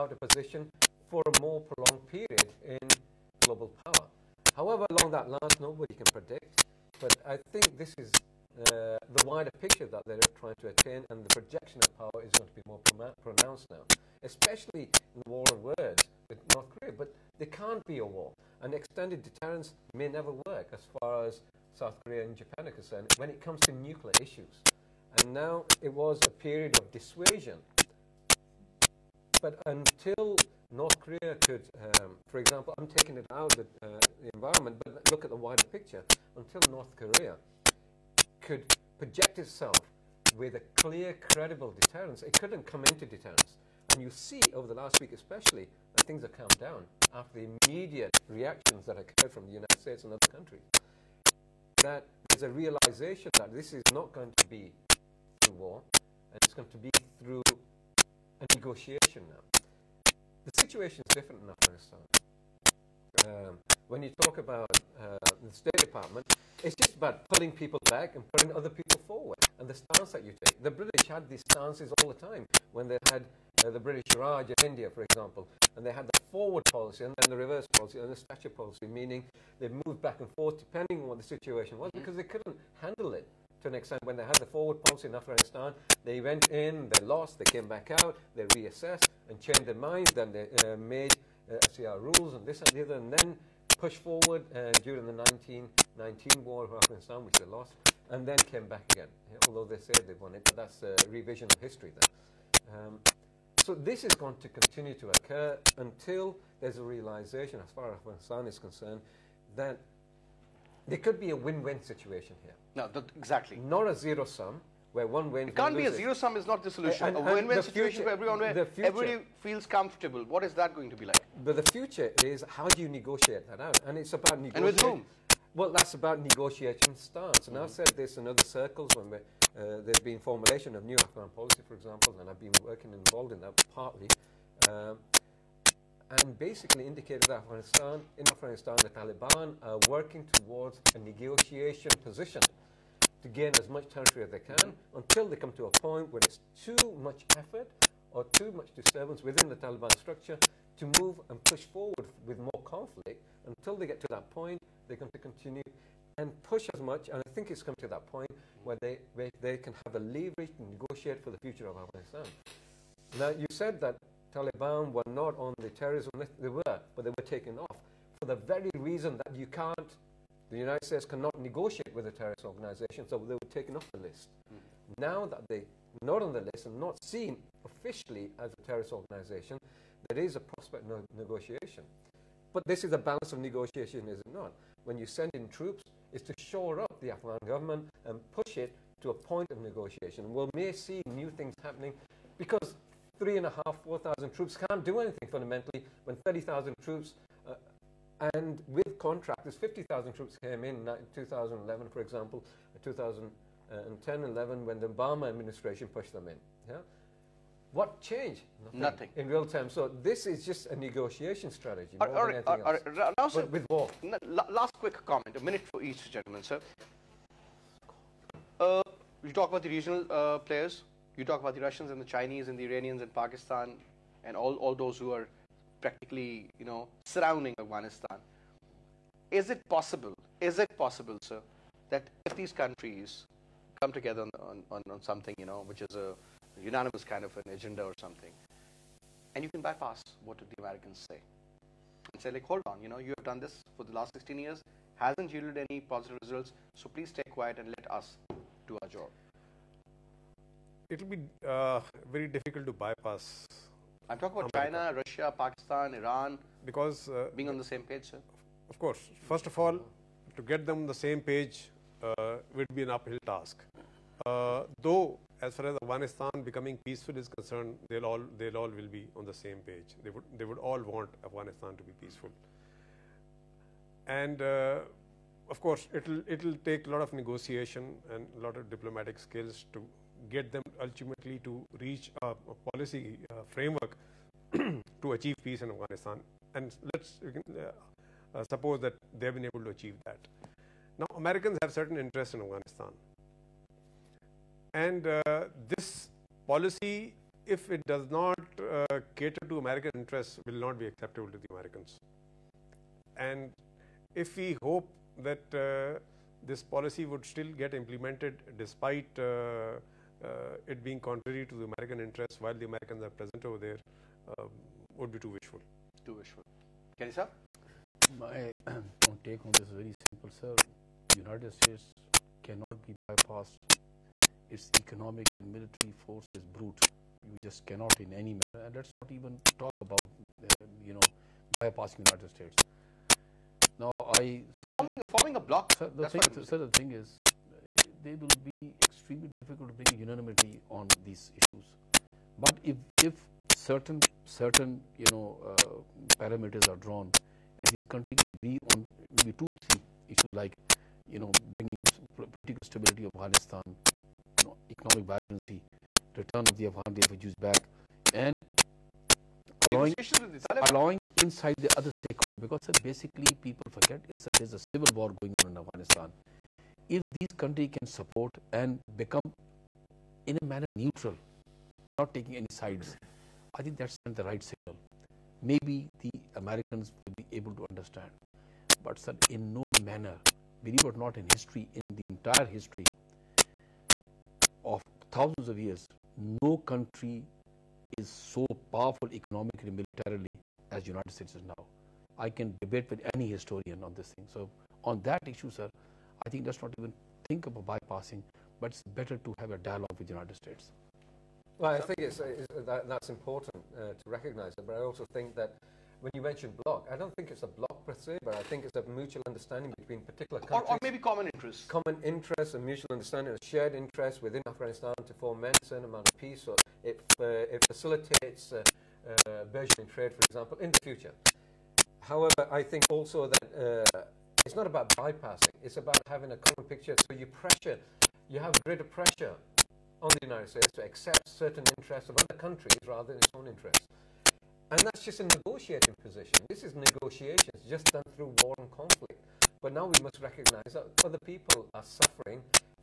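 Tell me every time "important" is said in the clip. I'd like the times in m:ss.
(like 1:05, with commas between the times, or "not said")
6:43.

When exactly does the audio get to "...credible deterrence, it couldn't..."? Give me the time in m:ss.
0:41.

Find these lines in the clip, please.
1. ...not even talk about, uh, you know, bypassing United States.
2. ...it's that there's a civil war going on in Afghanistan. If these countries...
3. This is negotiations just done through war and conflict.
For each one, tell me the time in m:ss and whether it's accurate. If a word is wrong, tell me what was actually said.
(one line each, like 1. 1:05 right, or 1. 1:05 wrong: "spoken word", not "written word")
1. 5:28 right
2. 6:04 right
3. 7:16 right.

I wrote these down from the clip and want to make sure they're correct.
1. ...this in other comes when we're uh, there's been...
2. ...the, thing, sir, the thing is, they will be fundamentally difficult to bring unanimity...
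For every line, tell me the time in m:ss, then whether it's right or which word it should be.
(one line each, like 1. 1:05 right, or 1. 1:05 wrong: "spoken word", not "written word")
1. 2:07 wrong: "circles", not "comes"
2. 5:35 wrong: "extremely", not "fundamentally".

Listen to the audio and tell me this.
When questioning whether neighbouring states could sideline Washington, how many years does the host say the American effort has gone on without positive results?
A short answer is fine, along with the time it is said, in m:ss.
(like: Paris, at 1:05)
16 years, at 4:04.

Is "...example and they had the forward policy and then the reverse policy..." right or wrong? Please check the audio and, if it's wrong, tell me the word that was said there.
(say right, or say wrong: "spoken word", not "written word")
right.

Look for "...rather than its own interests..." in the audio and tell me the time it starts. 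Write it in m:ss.
7:12.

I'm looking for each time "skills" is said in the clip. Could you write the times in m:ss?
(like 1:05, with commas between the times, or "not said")
4:39.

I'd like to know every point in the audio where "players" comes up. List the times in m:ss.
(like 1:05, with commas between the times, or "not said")
3:40.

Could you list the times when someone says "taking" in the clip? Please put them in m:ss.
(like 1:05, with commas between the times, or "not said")
0:32, 6:12.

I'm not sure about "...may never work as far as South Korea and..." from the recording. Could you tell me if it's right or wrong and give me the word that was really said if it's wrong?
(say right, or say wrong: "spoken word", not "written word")
right.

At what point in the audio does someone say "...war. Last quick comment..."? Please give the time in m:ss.
3:33.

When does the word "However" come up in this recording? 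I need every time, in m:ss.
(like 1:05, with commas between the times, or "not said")
0:04, 7:02.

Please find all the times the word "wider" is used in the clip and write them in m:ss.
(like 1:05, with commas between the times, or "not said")
0:09, 0:35.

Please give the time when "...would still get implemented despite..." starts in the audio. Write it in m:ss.
5:07.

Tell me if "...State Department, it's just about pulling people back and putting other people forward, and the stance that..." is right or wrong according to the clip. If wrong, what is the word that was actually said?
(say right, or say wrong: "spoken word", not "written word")
right.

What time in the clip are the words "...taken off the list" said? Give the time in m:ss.
2:53.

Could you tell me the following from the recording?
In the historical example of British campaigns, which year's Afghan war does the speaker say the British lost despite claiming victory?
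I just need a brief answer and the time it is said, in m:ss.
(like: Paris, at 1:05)
1919, at 1:35.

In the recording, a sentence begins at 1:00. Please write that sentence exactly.
The situation is different in Afghanistan.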